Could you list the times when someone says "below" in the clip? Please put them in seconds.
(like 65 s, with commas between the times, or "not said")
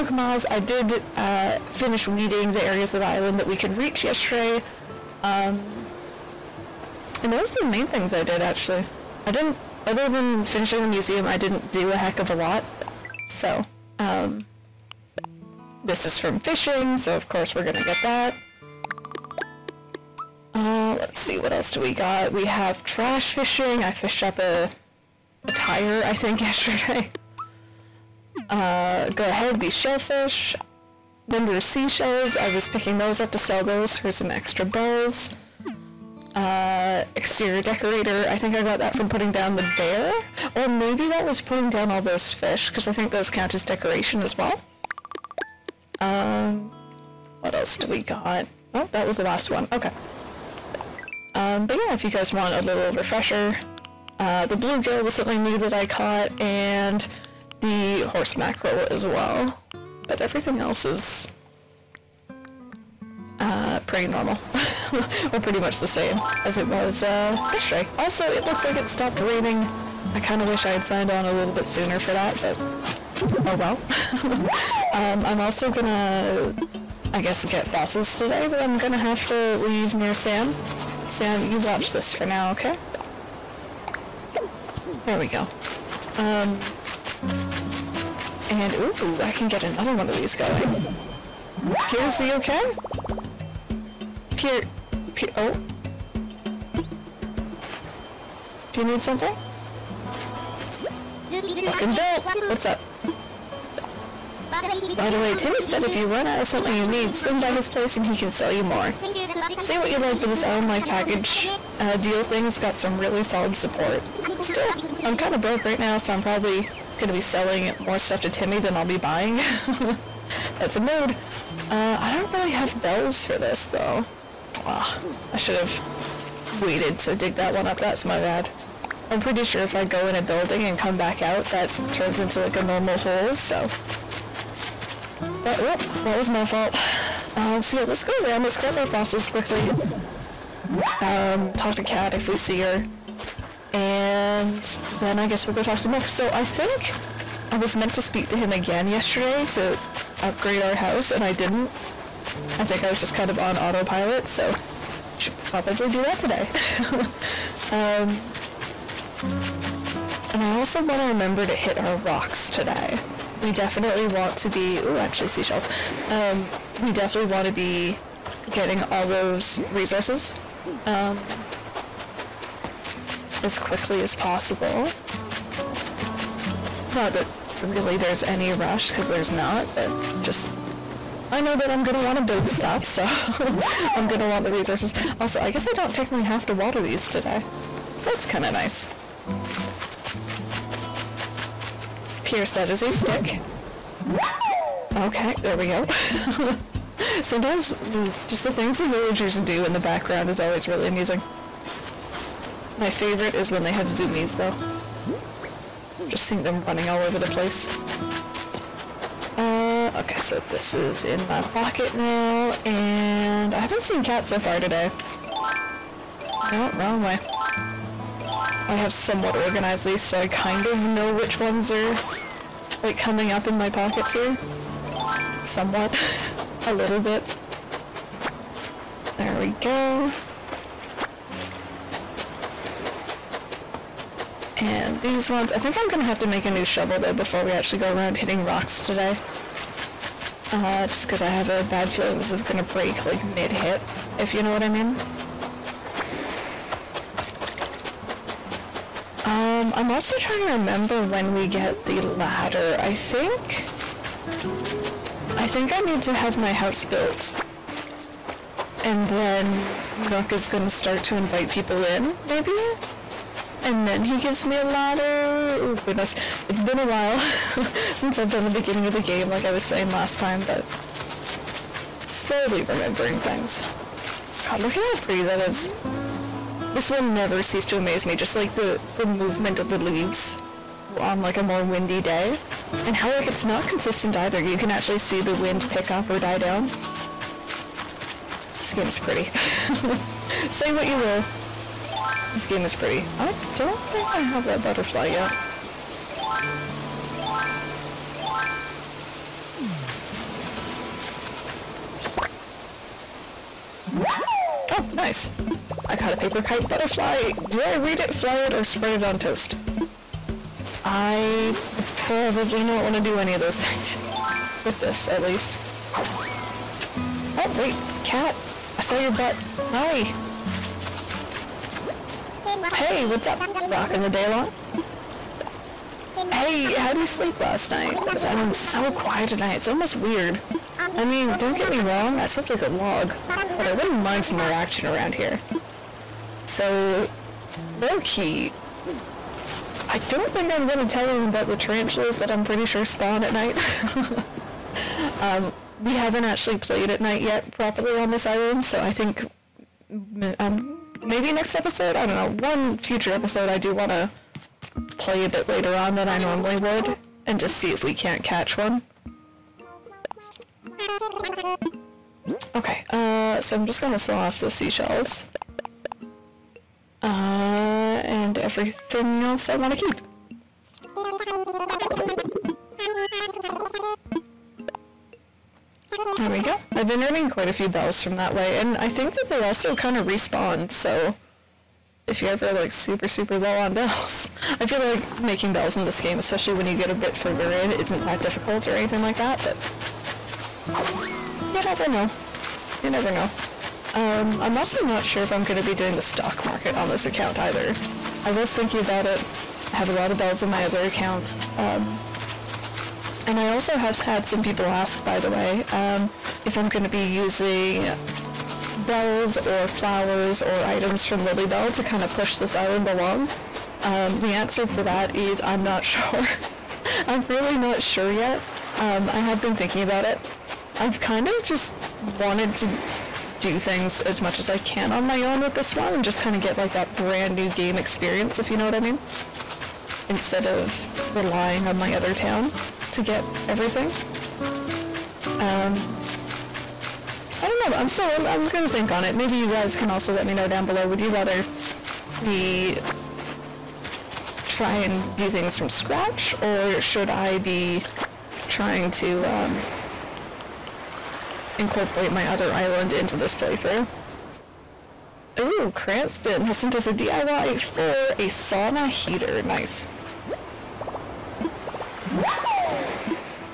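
440 s.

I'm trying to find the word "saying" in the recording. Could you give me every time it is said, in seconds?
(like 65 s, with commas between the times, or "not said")
269 s.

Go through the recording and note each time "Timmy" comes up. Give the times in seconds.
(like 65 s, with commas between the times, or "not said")
105 s, 118 s.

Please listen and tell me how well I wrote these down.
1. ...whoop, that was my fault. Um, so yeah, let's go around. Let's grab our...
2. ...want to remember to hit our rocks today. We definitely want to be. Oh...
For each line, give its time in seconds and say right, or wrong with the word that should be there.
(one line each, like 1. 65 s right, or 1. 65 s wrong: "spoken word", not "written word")
1. 135 s right
2. 160 s right.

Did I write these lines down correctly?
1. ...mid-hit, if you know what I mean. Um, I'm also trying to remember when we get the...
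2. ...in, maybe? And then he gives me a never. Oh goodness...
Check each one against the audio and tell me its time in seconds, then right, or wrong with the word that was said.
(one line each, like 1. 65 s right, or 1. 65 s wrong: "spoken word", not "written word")
1. 243 s right
2. 261 s wrong: "ladder", not "never".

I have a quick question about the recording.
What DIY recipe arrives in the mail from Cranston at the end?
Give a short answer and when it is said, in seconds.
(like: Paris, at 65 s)
sauna heater, at 458 s.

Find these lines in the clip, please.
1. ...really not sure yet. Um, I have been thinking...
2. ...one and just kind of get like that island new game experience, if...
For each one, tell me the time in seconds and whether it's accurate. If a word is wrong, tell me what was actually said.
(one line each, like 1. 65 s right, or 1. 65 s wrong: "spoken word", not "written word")
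1. 417 s right
2. 425 s wrong: "brand", not "island".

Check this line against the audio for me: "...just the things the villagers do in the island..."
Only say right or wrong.
wrong.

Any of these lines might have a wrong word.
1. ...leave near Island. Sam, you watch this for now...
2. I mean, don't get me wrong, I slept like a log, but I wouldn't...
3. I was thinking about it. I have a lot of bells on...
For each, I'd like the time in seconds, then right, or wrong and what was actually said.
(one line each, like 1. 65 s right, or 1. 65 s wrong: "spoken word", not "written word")
1. 79 s wrong: "Sam", not "Island"
2. 330 s right
3. 398 s right.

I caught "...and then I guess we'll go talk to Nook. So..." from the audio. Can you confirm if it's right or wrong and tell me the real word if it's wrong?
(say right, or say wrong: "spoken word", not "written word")
right.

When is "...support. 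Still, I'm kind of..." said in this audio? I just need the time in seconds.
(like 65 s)
113 s.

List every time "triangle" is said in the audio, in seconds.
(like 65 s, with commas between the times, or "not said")
not said.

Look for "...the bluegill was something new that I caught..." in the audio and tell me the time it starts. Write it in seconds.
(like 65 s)
54 s.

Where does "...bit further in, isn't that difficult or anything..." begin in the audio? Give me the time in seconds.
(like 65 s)
386 s.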